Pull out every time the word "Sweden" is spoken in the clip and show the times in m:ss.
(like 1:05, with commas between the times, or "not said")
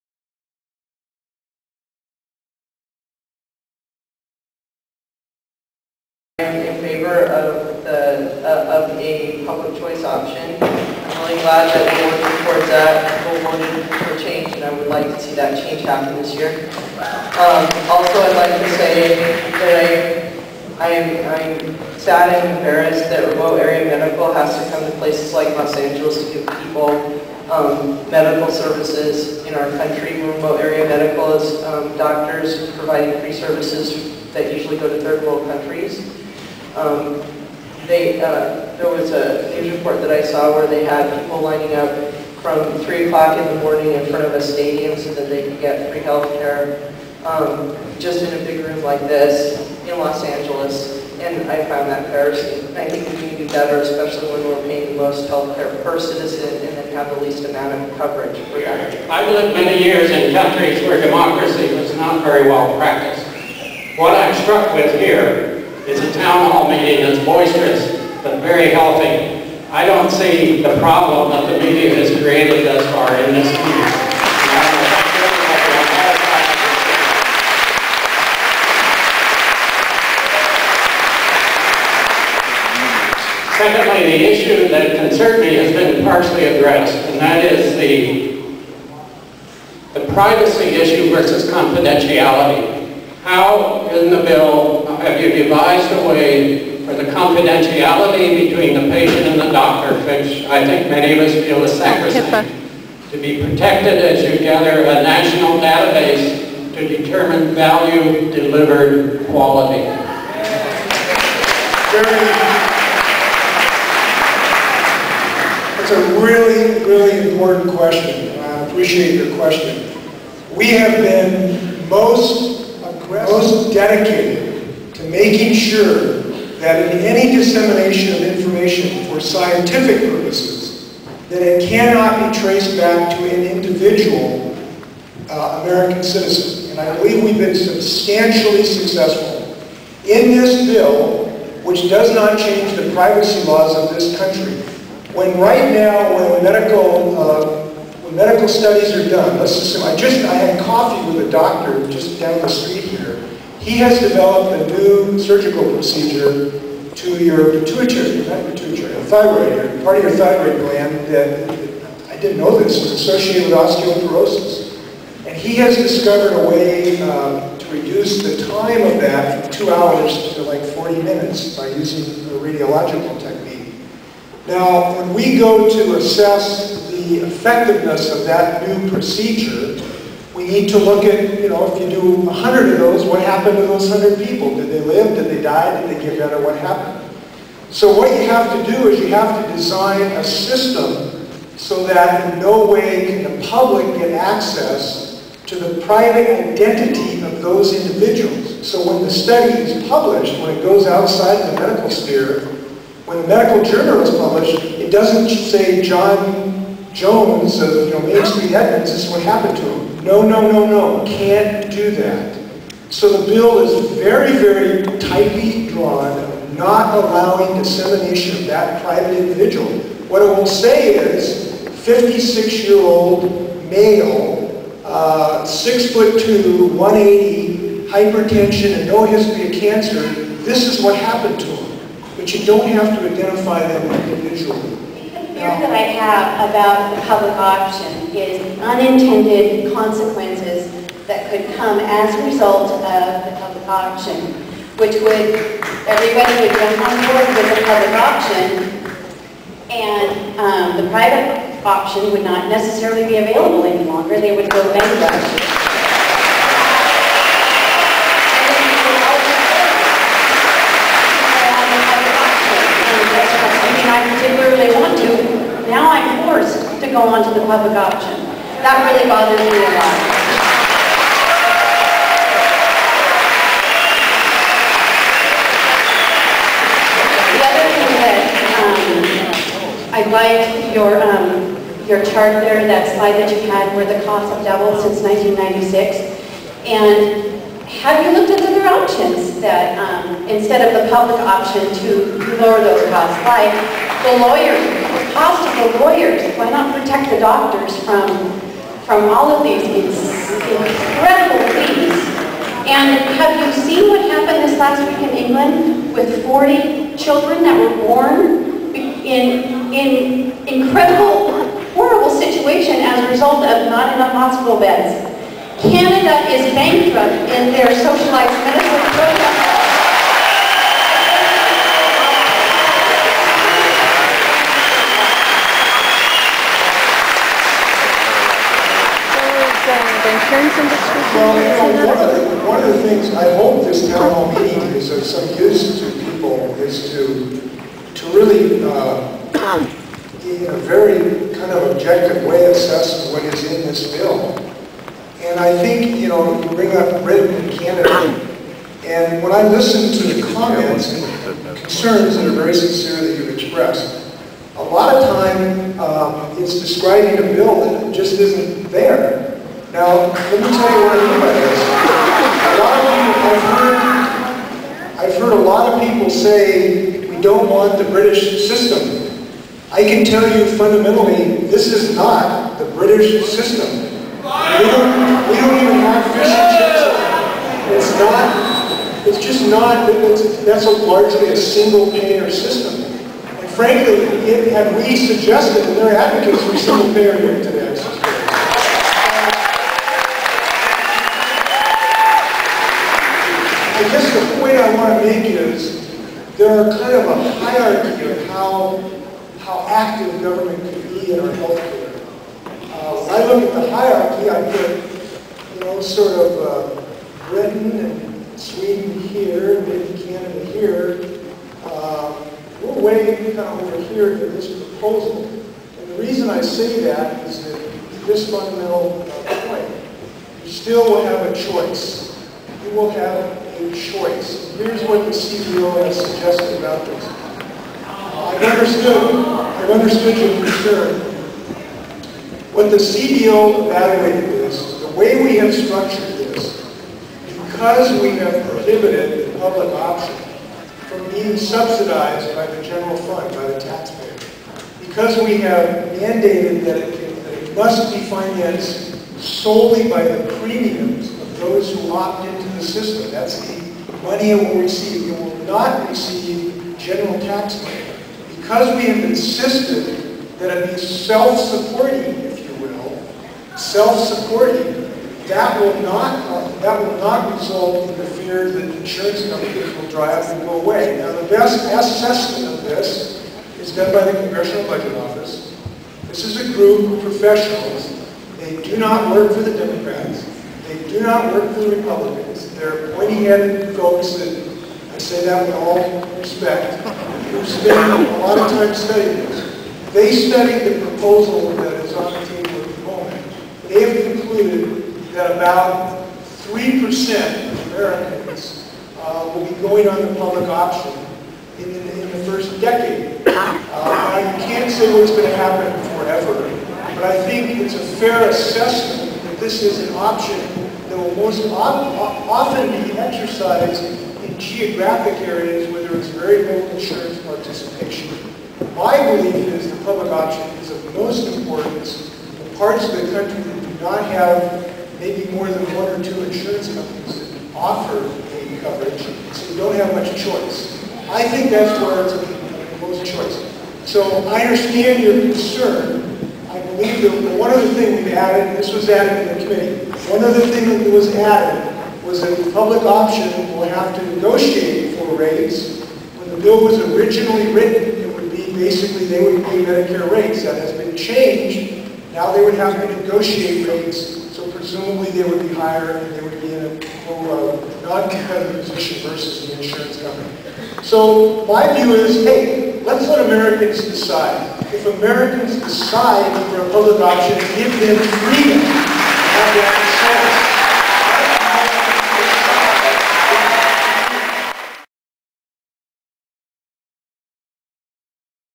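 6:48.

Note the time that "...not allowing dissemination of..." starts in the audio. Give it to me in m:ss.
3:36.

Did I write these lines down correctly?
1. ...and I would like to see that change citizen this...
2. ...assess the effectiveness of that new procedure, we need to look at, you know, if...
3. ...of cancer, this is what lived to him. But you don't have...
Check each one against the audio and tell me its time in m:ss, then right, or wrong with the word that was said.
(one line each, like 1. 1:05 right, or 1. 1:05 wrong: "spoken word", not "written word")
1. 0:14 wrong: "happen", not "citizen"
2. 2:55 right
3. 3:49 wrong: "happened", not "lived".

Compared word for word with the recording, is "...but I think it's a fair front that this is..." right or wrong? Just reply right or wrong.
wrong.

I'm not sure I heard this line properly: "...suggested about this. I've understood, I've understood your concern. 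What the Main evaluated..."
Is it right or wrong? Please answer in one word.
wrong.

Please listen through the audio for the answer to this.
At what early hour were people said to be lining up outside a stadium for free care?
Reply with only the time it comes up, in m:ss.
0:42.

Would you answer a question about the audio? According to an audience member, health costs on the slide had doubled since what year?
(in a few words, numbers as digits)
1996.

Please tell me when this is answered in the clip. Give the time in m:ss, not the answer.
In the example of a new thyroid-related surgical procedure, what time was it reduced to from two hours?
2:50.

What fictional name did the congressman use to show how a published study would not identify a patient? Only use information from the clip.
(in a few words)
John Jones.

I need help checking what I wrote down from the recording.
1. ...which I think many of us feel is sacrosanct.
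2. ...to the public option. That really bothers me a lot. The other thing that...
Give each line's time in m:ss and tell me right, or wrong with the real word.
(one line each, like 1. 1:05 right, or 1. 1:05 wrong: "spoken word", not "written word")
1. 1:40 right
2. 4:27 right.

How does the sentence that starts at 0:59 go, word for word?
I've lived many years in countries where democracy was not very well practiced.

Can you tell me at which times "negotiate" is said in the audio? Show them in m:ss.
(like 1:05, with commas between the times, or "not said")
9:04, 9:13.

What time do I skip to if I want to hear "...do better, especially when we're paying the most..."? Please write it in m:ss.
0:53.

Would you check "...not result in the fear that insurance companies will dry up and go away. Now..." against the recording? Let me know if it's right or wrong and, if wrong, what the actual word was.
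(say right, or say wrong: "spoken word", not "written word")
right.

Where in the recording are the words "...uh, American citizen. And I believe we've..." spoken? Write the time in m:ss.
2:15.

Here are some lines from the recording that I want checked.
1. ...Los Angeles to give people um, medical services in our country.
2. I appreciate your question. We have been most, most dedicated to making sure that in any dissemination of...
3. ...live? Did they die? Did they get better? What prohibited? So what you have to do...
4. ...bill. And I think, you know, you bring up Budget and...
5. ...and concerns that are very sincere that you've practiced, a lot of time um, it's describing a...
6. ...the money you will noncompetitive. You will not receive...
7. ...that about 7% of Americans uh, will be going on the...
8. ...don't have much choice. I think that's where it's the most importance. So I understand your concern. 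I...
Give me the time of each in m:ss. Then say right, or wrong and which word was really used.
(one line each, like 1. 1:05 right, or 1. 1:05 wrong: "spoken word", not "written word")
1. 0:25 right
2. 1:58 right
3. 3:04 wrong: "happened", not "prohibited"
4. 5:43 wrong: "Britain", not "Budget"
5. 5:50 wrong: "expressed", not "practiced"
6. 7:33 wrong: "receive", not "noncompetitive"
7. 8:15 wrong: "3", not "7"
8. 8:49 wrong: "choice", not "importance".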